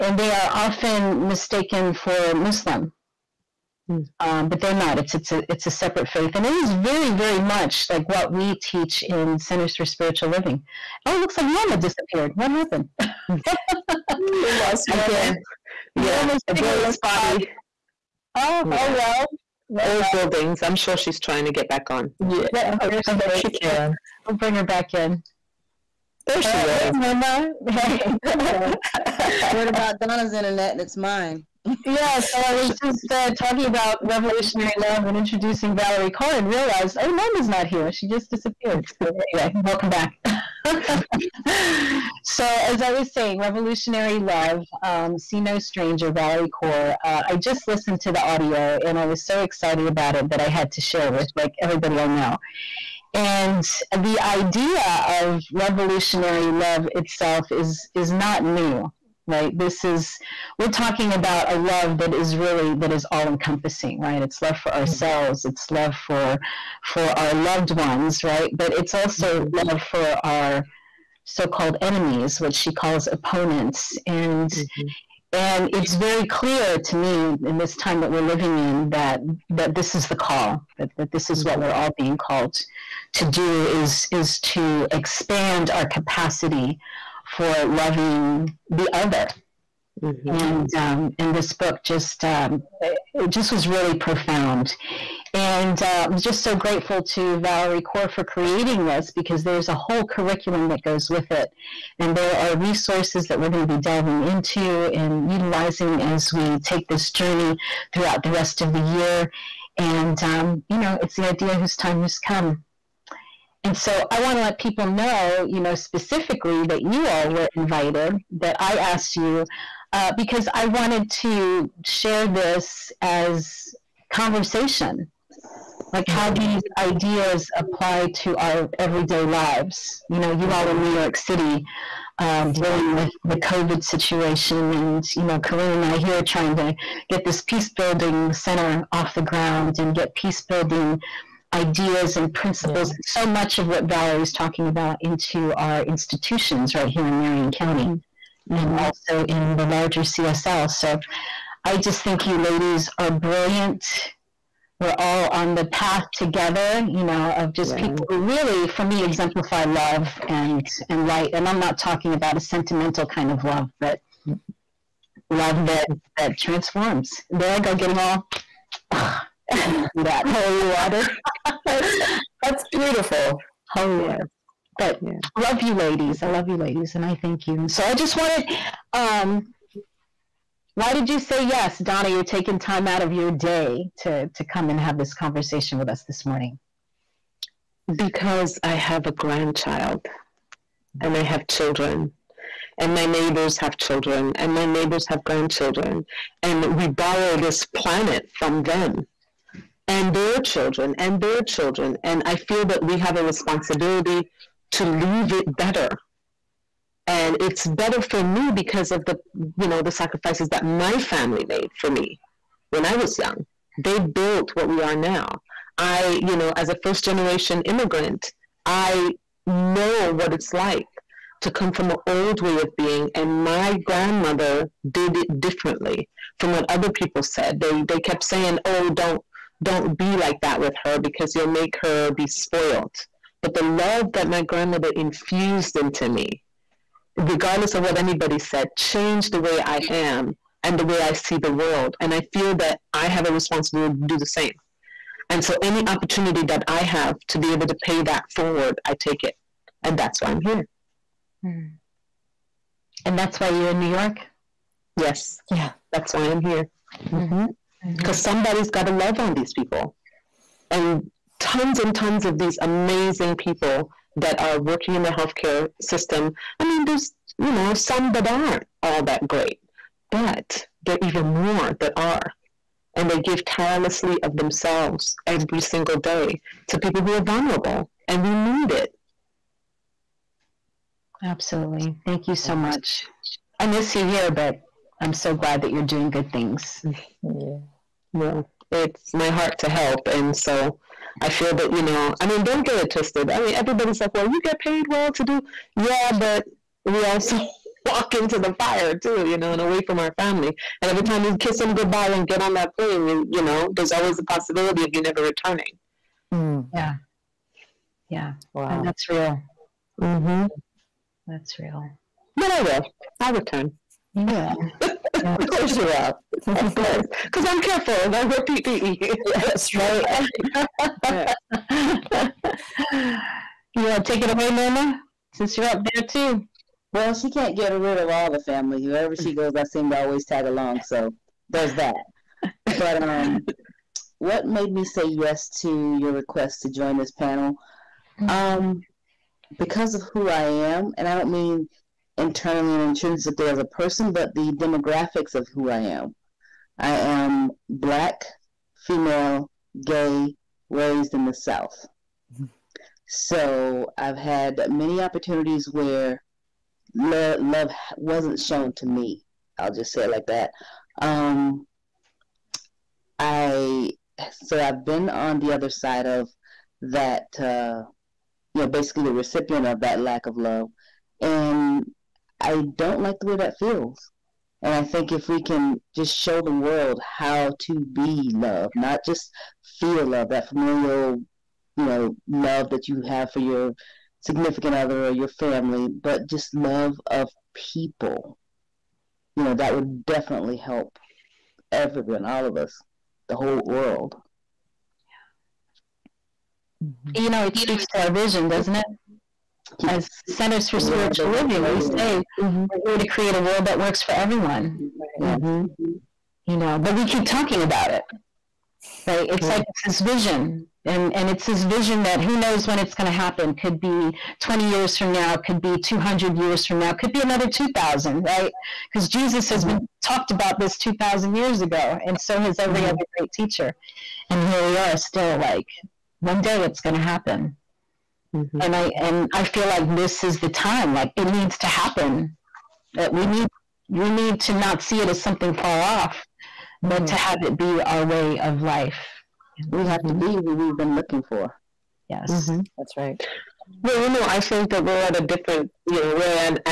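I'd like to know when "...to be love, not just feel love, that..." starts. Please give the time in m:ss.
6:17.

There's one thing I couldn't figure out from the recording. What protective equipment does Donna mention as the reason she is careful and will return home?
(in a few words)
PPE.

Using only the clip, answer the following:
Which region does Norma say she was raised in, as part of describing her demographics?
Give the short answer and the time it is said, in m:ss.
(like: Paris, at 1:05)
the South, at 5:51.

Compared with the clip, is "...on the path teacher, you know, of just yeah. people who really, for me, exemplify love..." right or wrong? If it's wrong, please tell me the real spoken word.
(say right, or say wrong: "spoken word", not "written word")
wrong: "together", not "teacher".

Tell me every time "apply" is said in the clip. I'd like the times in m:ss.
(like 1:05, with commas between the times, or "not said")
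2:07.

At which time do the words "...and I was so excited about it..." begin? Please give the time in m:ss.
0:48.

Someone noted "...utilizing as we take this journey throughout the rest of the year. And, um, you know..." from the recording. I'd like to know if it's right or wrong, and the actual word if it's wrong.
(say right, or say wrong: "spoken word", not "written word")
right.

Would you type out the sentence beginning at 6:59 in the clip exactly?
been talked about this 2000 years ago and so has every mm-hmm.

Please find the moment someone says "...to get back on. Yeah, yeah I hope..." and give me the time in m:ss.
0:21.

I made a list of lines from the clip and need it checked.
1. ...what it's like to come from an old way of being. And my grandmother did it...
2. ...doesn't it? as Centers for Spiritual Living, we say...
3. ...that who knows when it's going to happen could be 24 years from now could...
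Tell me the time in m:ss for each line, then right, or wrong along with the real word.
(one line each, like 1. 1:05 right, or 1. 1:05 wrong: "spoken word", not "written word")
1. 3:40 right
2. 6:38 right
3. 6:52 wrong: "20", not "24".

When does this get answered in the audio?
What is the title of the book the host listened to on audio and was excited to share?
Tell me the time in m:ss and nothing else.
0:45.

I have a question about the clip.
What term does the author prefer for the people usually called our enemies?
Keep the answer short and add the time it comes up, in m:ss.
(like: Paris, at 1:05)
opponents, at 1:13.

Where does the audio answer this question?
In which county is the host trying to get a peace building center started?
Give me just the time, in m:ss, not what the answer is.
2:27.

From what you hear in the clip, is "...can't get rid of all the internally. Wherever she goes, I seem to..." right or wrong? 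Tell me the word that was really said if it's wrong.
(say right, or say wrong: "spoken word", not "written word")
wrong: "family", not "internally".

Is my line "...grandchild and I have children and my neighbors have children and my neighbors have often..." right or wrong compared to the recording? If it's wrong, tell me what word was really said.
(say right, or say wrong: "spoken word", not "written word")
wrong: "grandchildren", not "often".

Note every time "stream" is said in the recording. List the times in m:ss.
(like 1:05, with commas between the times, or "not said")
not said.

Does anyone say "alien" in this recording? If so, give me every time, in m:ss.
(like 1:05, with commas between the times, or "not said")
not said.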